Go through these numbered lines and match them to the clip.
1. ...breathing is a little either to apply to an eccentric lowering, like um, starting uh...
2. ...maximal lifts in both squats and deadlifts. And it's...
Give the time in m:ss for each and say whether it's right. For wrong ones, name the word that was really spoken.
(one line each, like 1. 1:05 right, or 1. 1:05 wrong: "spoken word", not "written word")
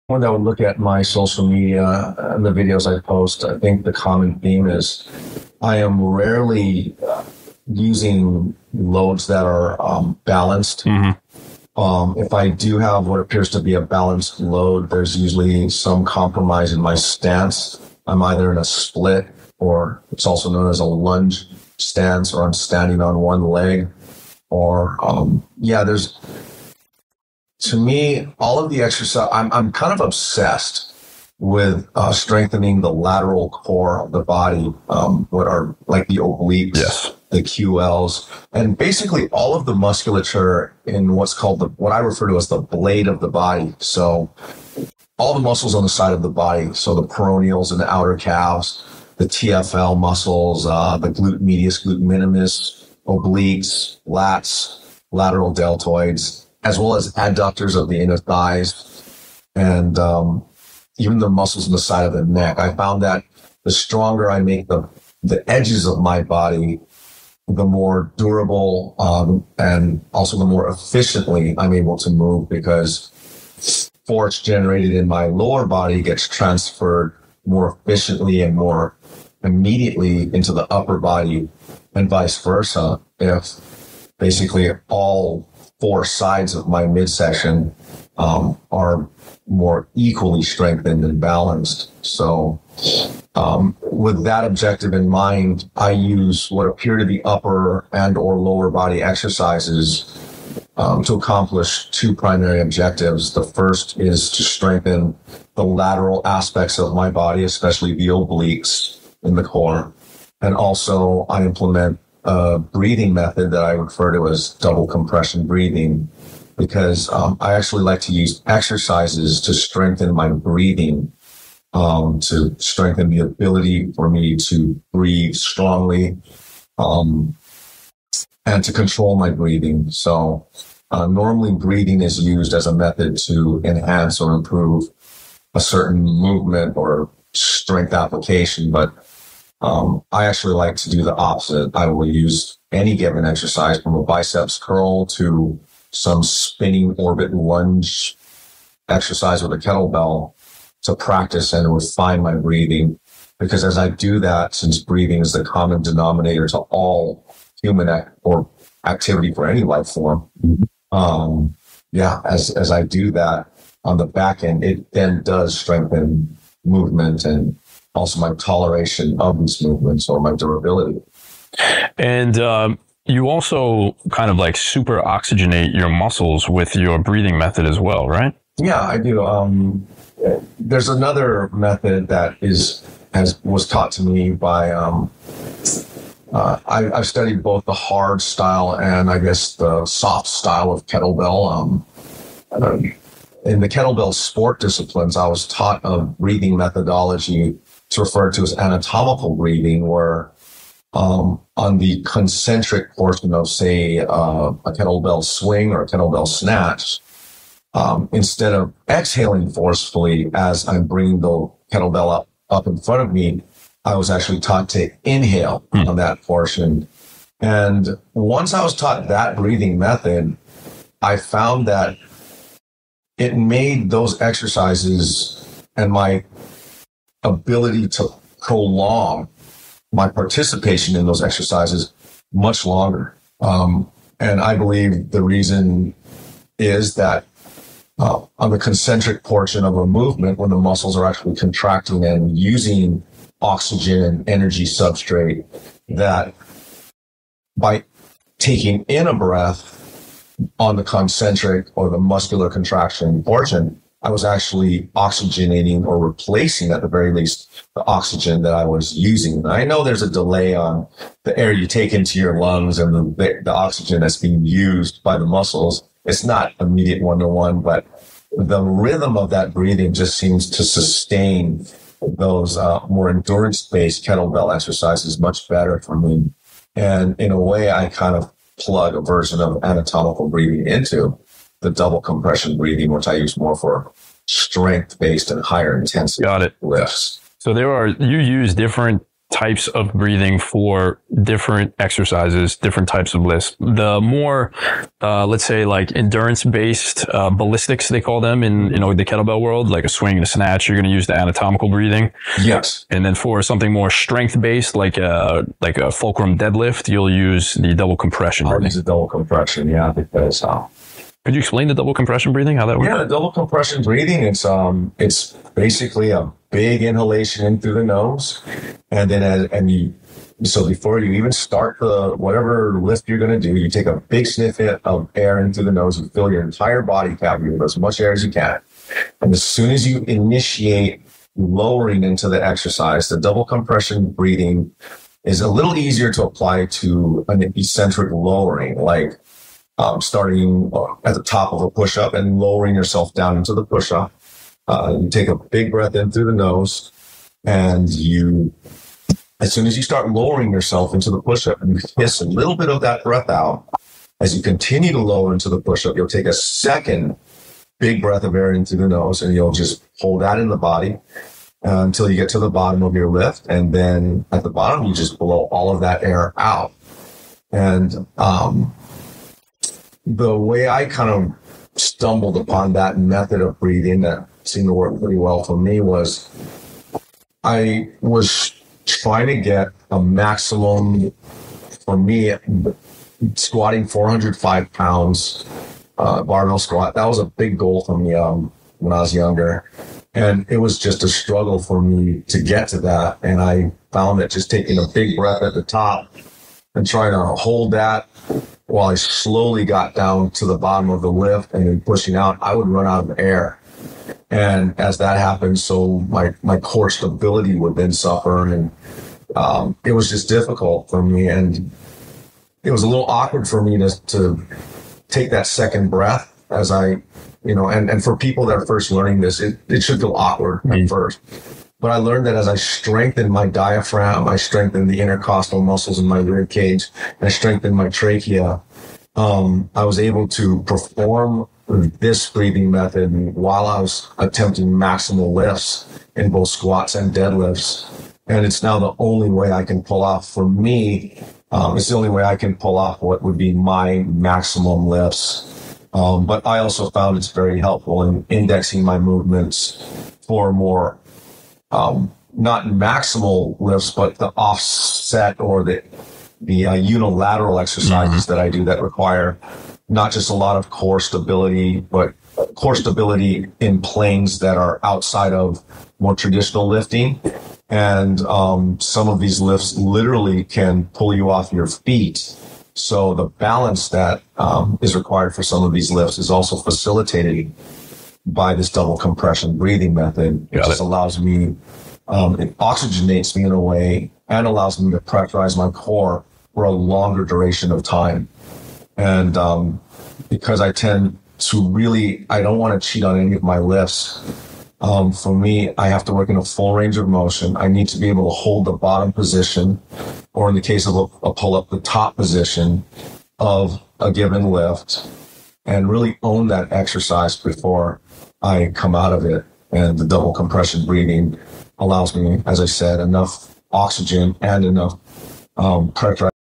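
1. 5:34 wrong: "easier", not "either"
2. 7:14 right.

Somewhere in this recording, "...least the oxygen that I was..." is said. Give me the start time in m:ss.
4:17.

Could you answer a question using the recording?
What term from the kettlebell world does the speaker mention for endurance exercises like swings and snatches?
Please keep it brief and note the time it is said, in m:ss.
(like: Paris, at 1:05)
ballistics, at 4:57.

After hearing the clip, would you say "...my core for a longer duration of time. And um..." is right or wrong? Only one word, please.
right.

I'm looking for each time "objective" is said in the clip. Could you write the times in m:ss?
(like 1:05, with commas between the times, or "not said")
1:34, 1:42.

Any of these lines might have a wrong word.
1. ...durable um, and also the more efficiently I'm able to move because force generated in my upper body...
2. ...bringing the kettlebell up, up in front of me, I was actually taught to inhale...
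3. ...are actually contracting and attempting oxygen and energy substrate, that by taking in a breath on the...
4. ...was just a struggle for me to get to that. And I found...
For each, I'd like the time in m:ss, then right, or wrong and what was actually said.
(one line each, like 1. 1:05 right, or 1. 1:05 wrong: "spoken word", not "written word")
1. 1:08 wrong: "lower", not "upper"
2. 3:30 right
3. 4:00 wrong: "using", not "attempting"
4. 6:30 right.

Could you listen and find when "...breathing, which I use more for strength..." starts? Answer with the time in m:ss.
4:42.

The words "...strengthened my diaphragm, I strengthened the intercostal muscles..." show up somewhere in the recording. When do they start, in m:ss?
7:02.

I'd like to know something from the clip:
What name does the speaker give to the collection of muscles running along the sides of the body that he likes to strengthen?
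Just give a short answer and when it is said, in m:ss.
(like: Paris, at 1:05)
the blade of the body, at 0:42.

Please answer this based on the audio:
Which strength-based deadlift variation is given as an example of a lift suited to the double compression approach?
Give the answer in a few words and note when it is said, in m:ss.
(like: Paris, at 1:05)
fulcrum deadlift, at 5:05.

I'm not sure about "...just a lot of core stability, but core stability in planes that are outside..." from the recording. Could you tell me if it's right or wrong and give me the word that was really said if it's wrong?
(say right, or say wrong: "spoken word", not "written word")
right.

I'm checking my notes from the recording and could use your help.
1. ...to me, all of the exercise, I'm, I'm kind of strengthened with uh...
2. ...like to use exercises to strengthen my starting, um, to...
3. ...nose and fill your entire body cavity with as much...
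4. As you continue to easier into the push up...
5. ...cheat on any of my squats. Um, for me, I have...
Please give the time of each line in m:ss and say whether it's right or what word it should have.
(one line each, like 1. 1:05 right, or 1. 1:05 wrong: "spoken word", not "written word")
1. 0:27 wrong: "obsessed", not "strengthened"
2. 1:57 wrong: "breathing", not "starting"
3. 5:25 right
4. 5:54 wrong: "lower", not "easier"
5. 8:12 wrong: "lifts", not "squats".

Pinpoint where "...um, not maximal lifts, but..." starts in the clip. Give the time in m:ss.
7:31.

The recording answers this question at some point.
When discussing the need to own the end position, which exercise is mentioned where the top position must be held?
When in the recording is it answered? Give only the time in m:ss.
8:21.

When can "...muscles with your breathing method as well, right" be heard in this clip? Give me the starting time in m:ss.
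2:55.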